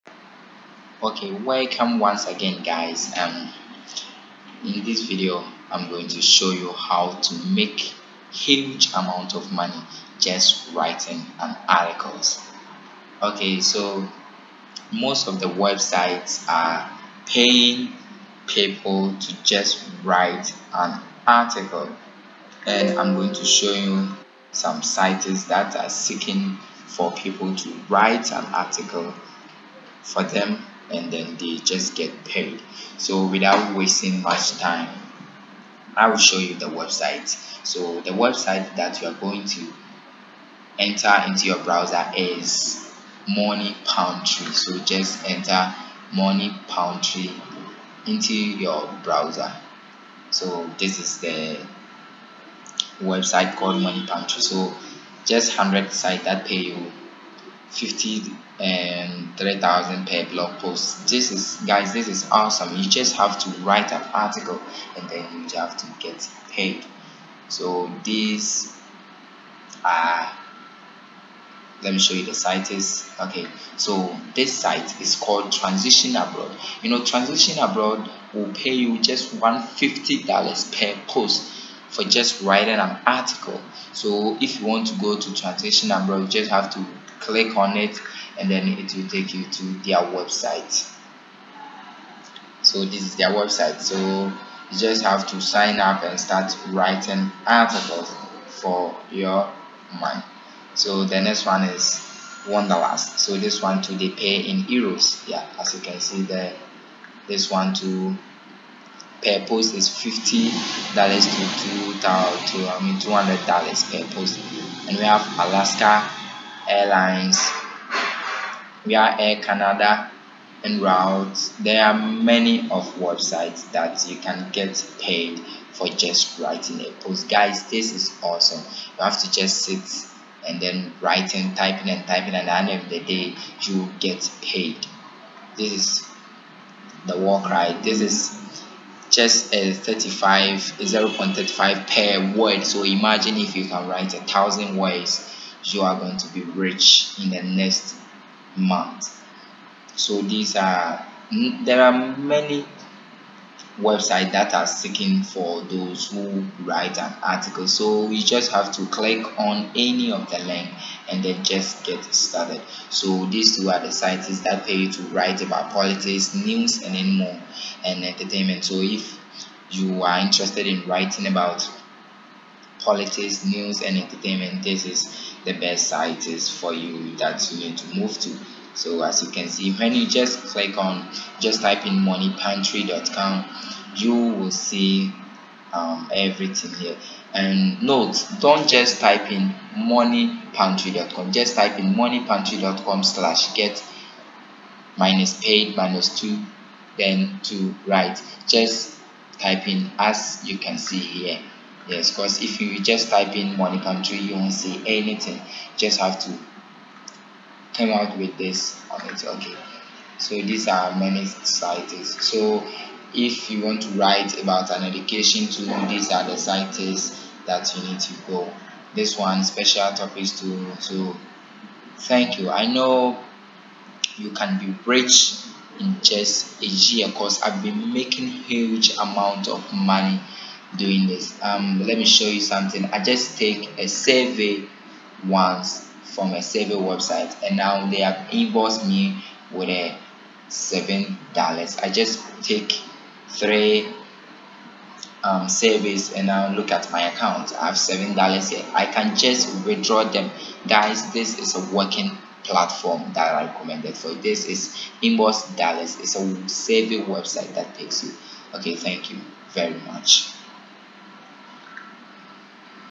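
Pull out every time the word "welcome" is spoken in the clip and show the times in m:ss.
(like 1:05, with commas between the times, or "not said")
0:01.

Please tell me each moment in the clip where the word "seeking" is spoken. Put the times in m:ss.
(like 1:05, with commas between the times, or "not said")
0:25, 2:34.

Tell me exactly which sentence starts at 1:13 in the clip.
Okay, so this site is called Transition Abroad.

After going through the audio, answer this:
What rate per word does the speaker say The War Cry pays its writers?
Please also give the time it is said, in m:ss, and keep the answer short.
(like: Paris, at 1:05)
0.35, at 2:20.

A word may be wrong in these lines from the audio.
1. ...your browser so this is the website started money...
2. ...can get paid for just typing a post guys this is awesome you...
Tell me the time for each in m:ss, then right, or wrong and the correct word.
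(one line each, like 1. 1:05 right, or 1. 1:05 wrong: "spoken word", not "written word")
1. 0:48 wrong: "called", not "started"
2. 2:04 wrong: "writing", not "typing".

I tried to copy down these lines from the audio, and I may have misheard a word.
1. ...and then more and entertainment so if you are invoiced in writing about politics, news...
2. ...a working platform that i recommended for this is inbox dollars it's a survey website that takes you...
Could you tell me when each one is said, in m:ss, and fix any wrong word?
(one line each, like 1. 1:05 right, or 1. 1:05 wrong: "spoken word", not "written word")
1. 2:46 wrong: "interested", not "invoiced"
2. 4:11 right.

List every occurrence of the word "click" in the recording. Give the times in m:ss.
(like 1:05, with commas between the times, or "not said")
1:27, 2:38, 3:00.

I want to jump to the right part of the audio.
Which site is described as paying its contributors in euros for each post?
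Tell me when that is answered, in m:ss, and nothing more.
1:42.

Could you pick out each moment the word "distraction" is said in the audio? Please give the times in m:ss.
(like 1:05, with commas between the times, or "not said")
not said.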